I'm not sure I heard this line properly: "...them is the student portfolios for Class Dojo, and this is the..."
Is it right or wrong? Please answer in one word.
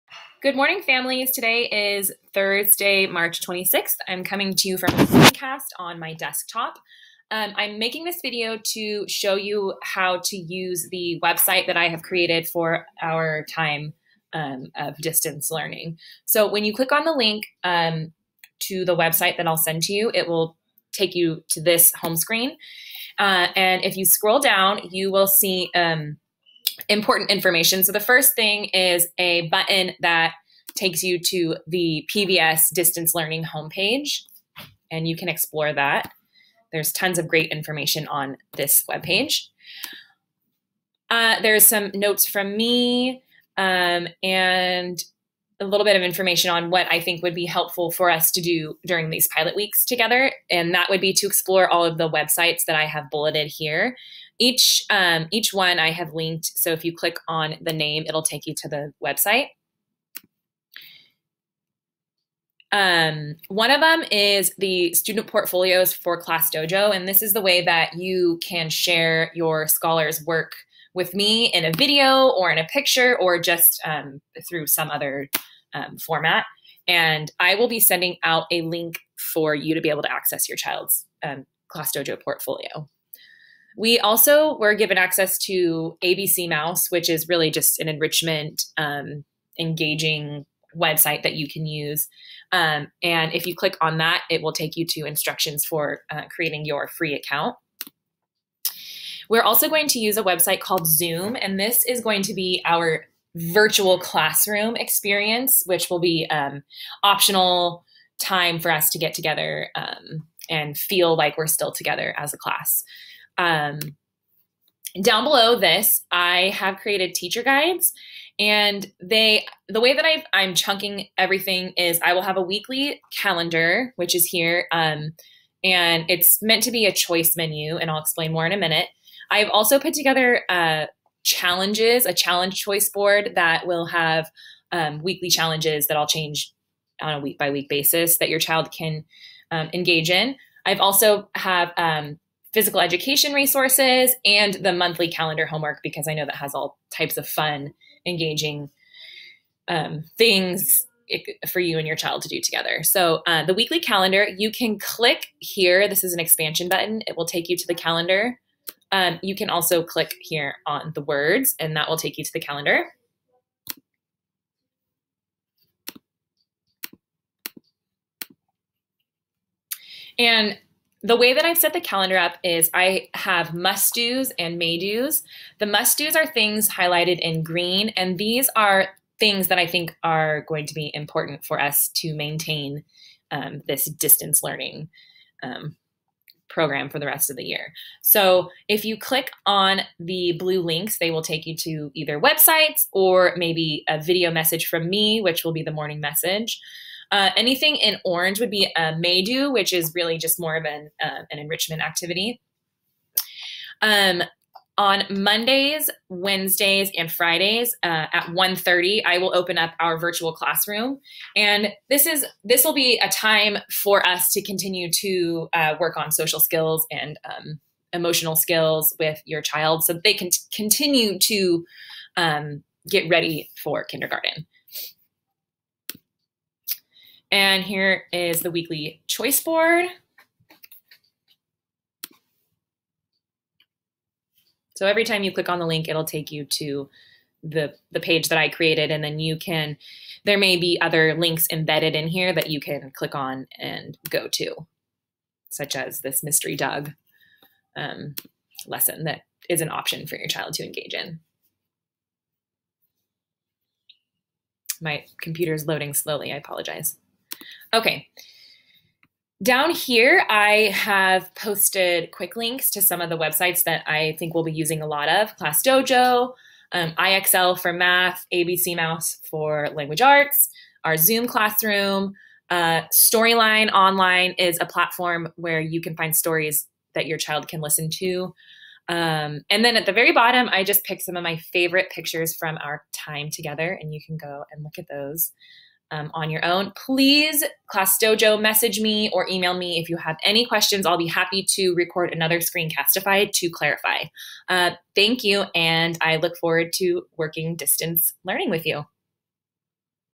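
right.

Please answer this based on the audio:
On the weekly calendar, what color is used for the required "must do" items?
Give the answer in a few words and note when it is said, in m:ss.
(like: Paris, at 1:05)
green, at 2:57.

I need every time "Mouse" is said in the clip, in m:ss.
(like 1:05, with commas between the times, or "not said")
1:26, 4:28.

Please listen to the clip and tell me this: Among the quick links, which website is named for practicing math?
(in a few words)
IXL.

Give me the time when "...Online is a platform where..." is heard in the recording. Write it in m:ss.
4:33.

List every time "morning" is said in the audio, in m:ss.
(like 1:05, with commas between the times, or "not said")
0:00, 3:15.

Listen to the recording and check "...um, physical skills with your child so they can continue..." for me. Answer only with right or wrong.
wrong.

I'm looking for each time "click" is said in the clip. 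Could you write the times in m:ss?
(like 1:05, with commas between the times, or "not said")
0:16, 0:56, 1:33, 2:34, 2:39, 3:08, 3:55, 4:02.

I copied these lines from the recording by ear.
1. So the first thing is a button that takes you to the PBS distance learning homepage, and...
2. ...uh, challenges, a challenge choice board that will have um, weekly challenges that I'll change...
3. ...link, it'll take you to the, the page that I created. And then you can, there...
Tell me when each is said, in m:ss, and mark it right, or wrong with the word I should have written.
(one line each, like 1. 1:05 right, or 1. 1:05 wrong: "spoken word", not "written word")
1. 0:27 right
2. 2:10 right
3. 3:55 right.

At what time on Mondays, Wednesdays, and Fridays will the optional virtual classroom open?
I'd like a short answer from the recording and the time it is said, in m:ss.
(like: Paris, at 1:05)
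1:30, at 3:28.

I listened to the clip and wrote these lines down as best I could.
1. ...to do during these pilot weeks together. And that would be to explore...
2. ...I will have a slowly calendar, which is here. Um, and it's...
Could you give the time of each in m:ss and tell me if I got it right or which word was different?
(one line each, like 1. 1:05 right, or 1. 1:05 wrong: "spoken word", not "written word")
1. 0:48 right
2. 2:02 wrong: "weekly", not "slowly".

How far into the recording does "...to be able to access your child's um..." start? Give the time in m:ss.
1:19.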